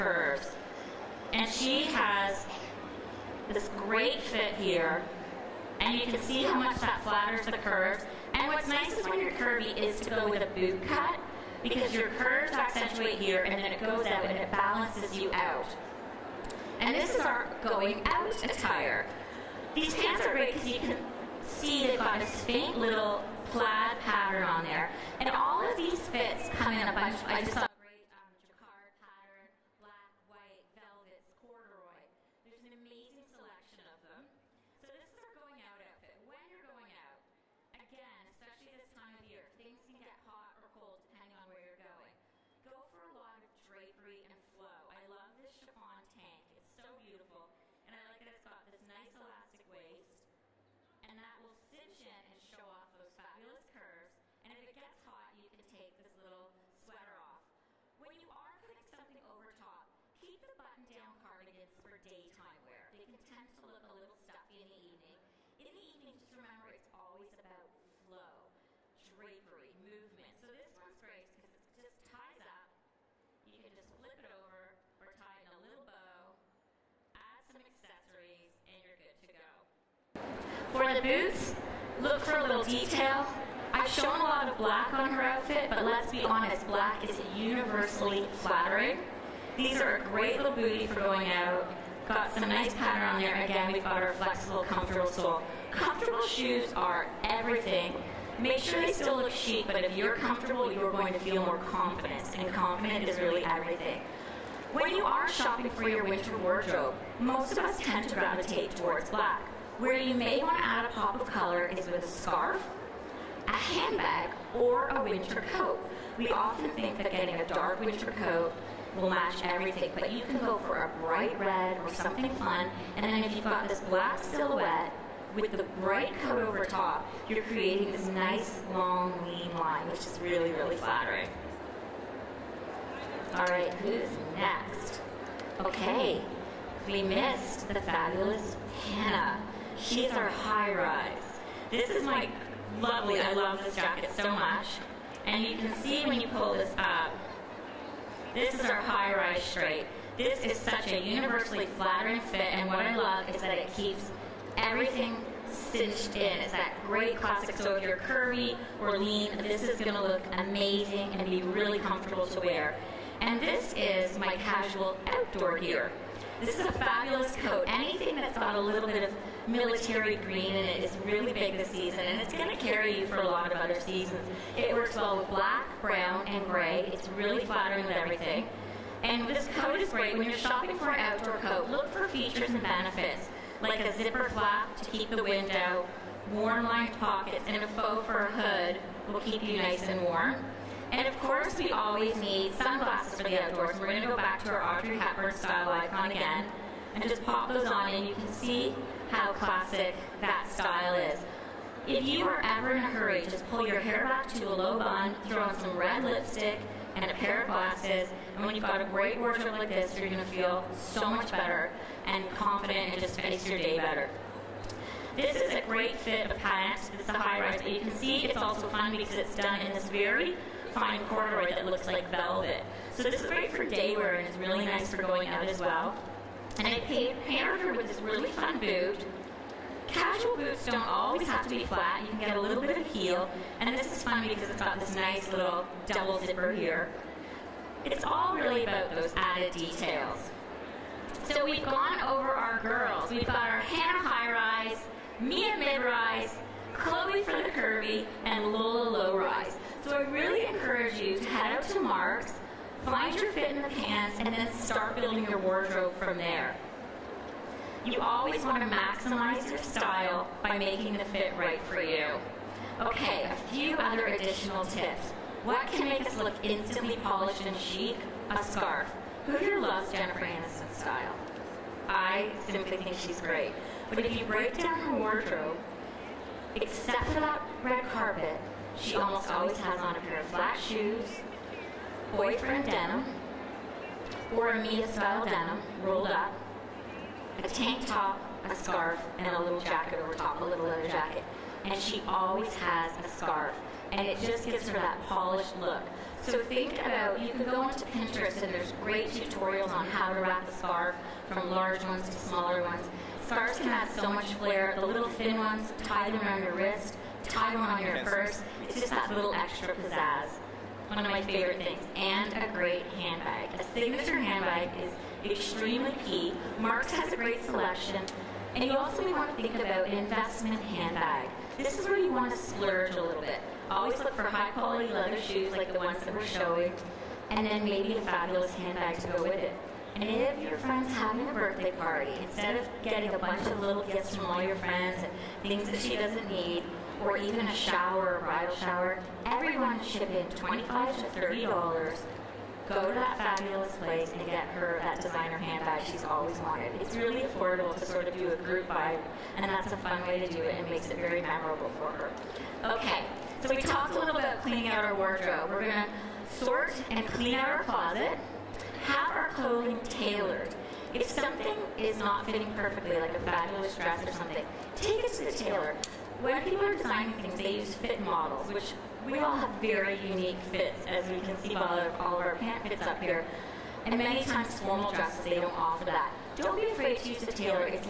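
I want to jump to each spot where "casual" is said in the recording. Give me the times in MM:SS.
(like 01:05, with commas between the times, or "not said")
02:44, 03:49.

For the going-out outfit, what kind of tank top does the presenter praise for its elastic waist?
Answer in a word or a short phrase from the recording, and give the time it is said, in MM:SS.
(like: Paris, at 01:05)
chiffon tank, at 00:45.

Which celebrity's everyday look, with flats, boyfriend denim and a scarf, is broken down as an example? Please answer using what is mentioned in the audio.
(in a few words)
Jennifer Aniston.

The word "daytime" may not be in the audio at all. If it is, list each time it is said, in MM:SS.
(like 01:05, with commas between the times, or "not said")
01:01.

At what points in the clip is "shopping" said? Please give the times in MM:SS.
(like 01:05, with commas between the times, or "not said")
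01:45, 03:00.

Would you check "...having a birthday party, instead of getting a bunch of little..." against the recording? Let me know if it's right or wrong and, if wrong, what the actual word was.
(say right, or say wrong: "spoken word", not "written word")
right.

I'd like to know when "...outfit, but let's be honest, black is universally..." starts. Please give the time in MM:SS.
01:25.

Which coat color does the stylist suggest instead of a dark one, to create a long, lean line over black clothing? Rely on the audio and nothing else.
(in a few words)
bright red.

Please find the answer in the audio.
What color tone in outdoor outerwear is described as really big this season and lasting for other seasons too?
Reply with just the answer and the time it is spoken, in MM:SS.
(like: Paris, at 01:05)
military green, at 02:49.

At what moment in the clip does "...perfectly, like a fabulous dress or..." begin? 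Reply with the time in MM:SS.
06:02.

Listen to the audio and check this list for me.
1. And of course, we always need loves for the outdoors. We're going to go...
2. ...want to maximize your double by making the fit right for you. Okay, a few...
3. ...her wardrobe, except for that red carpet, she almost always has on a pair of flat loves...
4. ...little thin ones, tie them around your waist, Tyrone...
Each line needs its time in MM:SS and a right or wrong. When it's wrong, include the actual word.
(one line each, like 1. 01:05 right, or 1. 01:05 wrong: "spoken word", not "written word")
1. 03:10 wrong: "sunglasses", not "loves"
2. 04:18 wrong: "style", not "double"
3. 04:34 wrong: "shoes", not "loves"
4. 05:04 wrong: "wrist", not "waist".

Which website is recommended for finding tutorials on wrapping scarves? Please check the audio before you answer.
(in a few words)
Pinterest.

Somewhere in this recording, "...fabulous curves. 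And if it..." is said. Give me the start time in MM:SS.
00:53.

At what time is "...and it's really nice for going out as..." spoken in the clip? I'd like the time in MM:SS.
03:44.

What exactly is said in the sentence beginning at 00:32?
There's an amazing selection of them.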